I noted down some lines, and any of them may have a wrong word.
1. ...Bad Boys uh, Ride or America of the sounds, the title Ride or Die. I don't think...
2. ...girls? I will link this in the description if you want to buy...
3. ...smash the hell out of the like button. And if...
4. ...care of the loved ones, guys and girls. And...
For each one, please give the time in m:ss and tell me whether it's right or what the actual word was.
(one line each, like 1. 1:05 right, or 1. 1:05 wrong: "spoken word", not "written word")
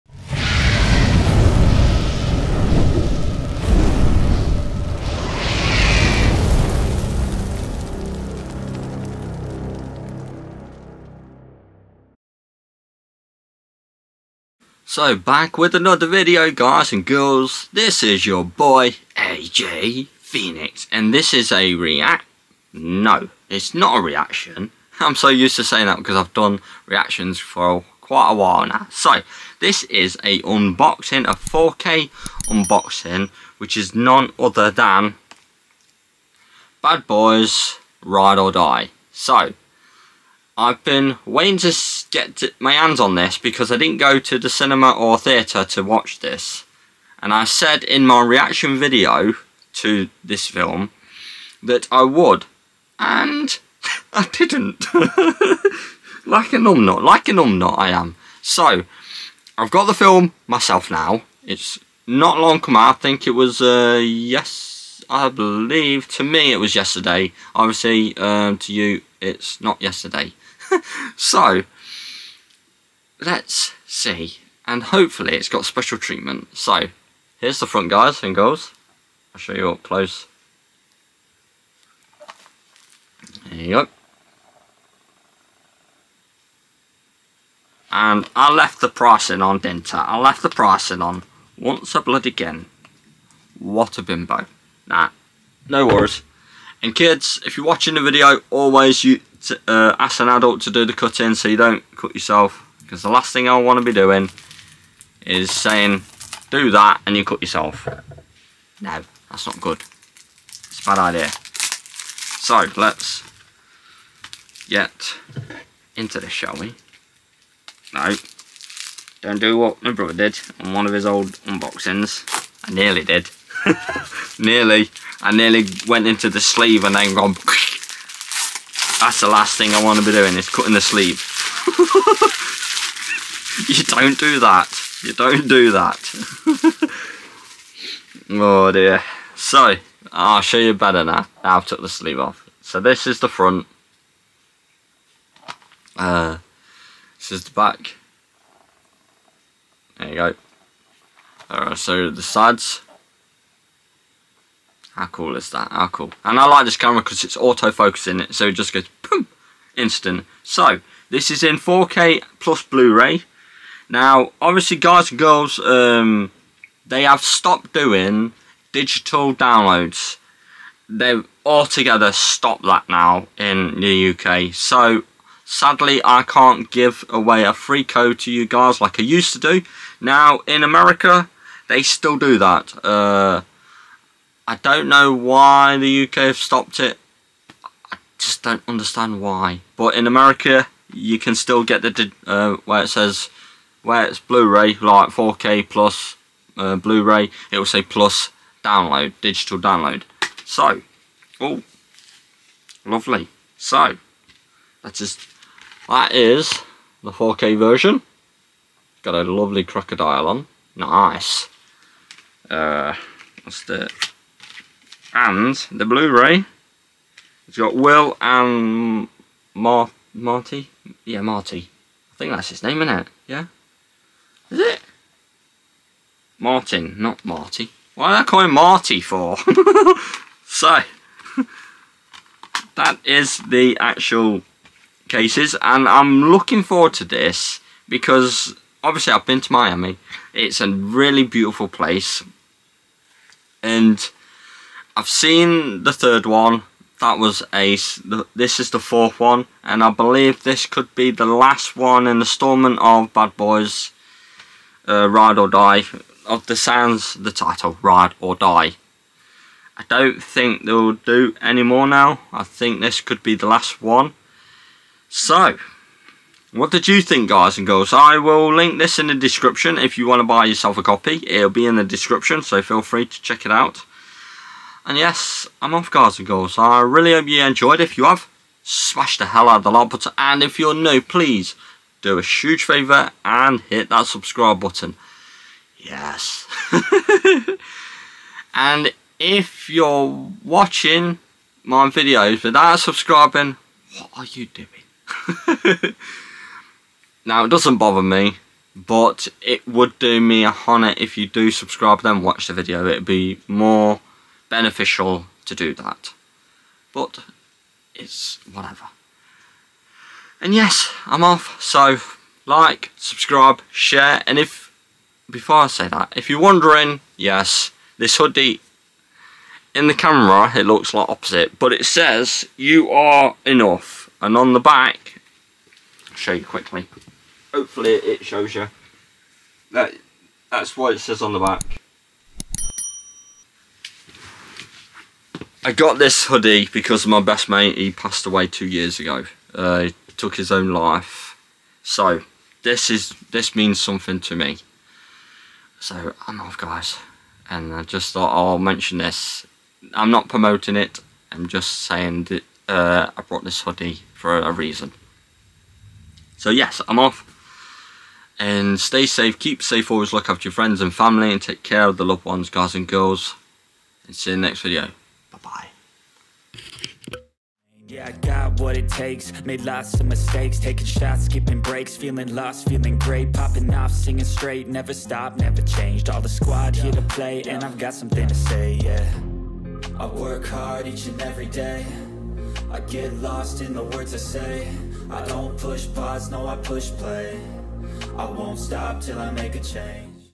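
1. 4:13 wrong: "Die", not "America"
2. 4:27 right
3. 4:38 right
4. 6:01 right.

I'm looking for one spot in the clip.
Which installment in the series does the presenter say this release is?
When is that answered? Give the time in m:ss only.
4:08.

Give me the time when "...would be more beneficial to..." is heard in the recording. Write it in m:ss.
5:02.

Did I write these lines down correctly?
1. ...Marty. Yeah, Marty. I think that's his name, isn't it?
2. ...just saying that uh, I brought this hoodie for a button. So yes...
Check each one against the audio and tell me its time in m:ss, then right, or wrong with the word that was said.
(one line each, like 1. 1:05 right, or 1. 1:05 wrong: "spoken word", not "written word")
1. 3:40 right
2. 5:51 wrong: "reason", not "button".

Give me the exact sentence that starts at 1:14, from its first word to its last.
And hopefully it's got special treatment.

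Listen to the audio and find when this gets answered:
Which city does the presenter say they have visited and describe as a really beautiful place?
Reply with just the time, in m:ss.
3:59.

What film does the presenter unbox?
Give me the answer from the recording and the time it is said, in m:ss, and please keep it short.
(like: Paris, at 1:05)
Bad Boys Ride or Die, at 0:36.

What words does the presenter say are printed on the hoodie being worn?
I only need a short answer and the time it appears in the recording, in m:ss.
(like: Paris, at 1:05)
You are enough, at 5:22.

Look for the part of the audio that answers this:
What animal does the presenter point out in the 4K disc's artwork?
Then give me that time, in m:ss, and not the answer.
3:29.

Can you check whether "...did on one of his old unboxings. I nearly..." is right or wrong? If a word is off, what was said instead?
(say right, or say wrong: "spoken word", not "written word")
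right.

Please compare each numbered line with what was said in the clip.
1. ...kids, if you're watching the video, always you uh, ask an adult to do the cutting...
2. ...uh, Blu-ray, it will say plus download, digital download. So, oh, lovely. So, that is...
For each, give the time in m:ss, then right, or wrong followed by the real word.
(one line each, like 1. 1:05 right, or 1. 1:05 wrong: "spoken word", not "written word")
1. 1:36 right
2. 3:16 right.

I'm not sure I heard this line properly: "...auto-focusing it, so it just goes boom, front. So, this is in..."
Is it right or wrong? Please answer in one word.
wrong.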